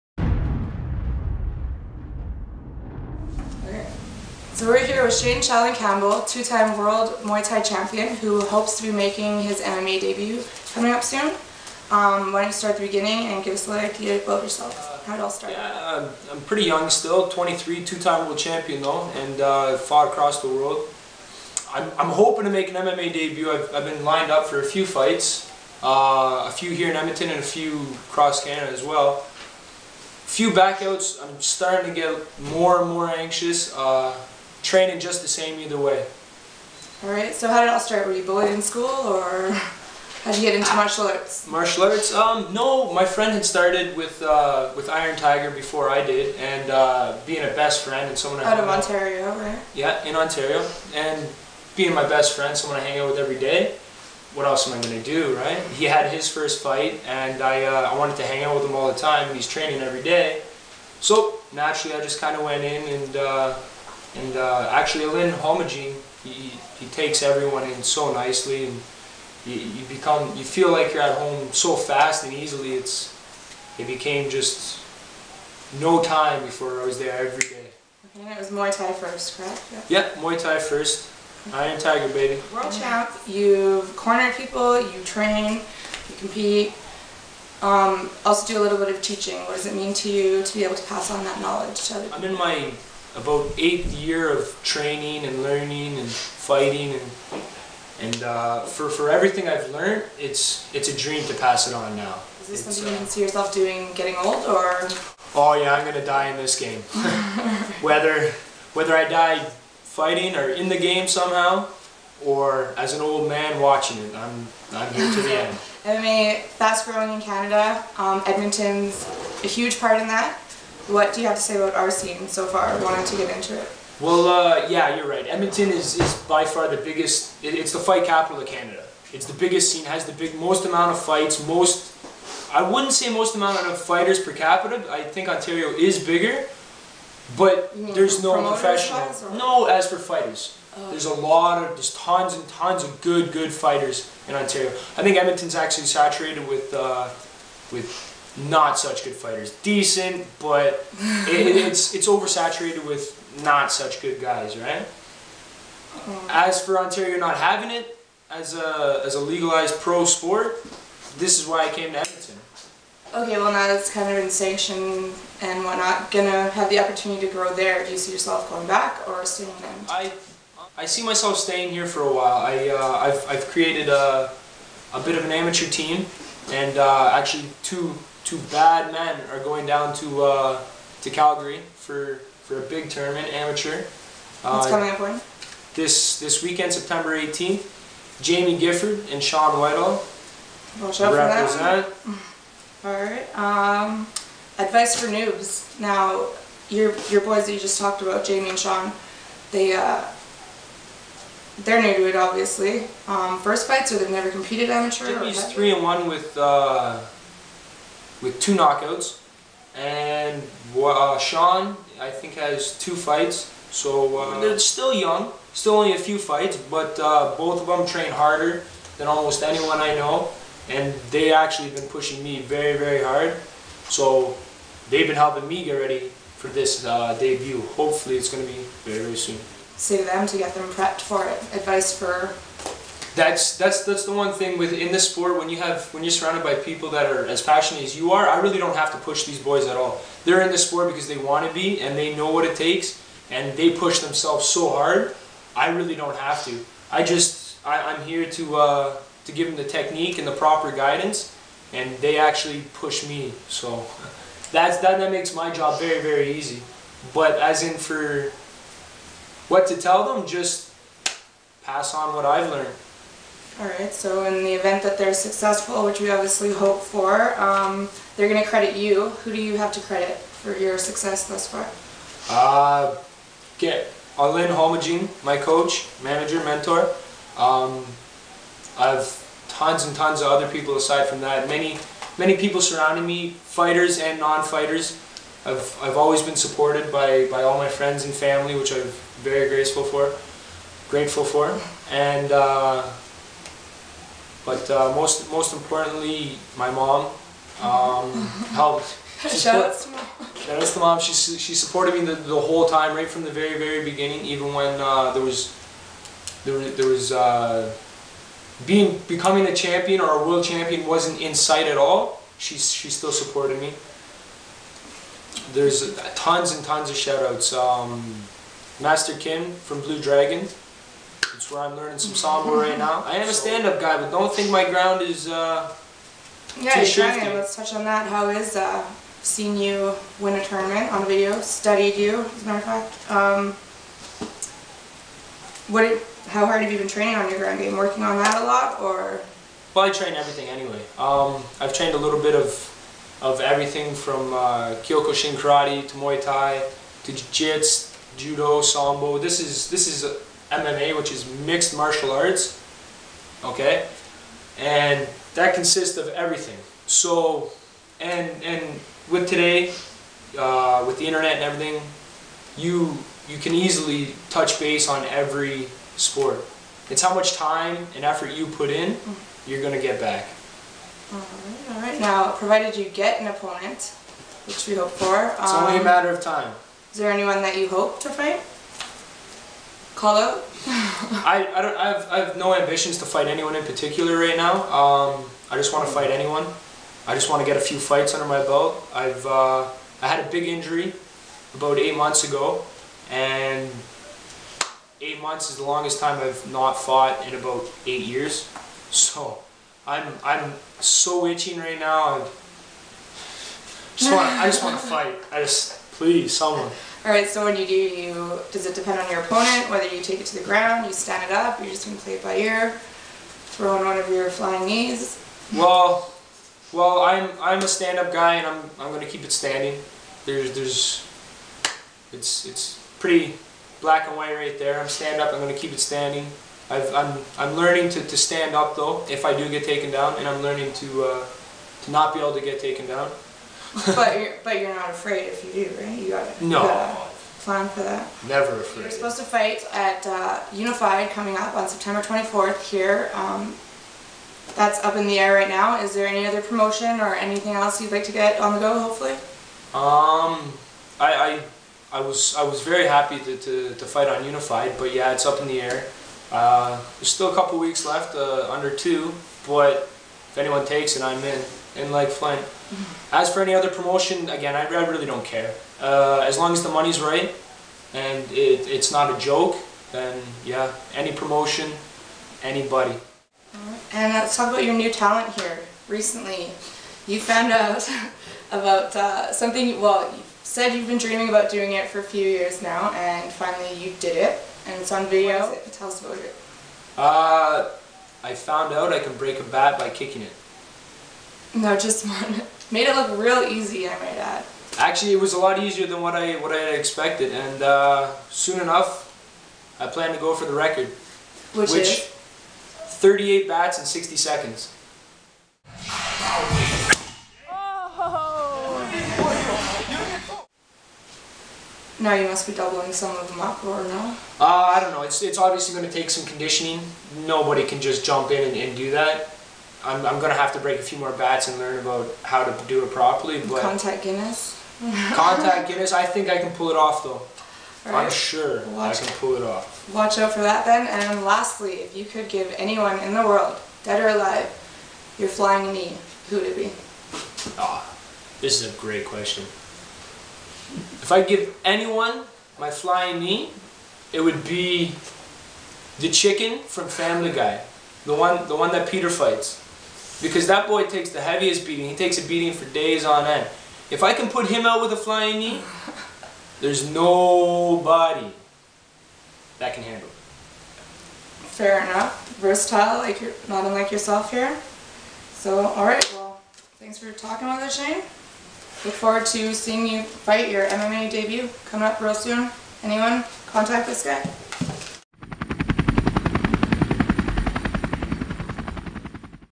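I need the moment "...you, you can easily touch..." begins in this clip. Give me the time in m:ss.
6:02.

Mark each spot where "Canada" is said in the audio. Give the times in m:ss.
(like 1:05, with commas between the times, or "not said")
0:28, 1:57, 2:08.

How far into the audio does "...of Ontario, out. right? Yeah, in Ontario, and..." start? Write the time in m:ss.
0:48.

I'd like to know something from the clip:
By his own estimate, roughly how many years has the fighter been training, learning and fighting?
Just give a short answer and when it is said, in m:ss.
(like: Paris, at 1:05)
8, at 1:33.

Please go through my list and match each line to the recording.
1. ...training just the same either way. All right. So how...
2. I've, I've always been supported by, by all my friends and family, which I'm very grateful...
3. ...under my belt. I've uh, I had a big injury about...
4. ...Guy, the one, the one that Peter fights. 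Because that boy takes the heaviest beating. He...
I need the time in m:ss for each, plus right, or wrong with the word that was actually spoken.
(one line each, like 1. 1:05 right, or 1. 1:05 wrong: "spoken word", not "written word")
1. 0:34 right
2. 4:45 right
3. 6:28 right
4. 9:07 right.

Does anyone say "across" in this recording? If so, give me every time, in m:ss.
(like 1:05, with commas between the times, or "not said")
0:20, 0:28.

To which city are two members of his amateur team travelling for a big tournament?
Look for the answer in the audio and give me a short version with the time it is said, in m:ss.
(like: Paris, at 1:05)
Calgary, at 3:01.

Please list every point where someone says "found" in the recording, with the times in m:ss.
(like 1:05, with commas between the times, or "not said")
7:57, 8:08.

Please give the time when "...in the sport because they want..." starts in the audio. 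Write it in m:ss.
4:00.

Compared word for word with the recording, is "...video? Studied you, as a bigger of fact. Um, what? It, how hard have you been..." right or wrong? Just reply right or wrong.
wrong.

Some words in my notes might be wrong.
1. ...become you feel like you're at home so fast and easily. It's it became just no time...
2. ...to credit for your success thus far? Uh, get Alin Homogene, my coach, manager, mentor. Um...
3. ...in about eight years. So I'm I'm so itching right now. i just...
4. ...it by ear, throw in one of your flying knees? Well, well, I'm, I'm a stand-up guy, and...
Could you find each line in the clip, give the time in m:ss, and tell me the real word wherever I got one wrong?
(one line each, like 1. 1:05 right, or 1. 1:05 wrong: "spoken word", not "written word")
1. 1:09 right
2. 4:29 right
3. 6:37 right
4. 6:52 right.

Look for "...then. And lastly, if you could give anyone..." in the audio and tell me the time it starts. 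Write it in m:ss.
8:50.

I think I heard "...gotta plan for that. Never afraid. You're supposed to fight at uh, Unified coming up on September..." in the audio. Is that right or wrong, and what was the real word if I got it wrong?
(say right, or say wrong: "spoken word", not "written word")
right.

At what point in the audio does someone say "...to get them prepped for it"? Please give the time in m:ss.
3:50.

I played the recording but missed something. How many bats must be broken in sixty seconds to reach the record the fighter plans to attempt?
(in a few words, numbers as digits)
38.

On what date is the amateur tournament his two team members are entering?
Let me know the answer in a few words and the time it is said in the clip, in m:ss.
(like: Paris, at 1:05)
September 18th, at 3:06.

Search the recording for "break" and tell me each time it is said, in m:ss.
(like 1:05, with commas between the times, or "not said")
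8:09, 8:40.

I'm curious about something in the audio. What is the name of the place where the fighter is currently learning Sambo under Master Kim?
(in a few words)
Blue Dragon.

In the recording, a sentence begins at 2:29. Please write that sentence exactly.
Decent, but it, it's it's oversaturated with not such good guys, right?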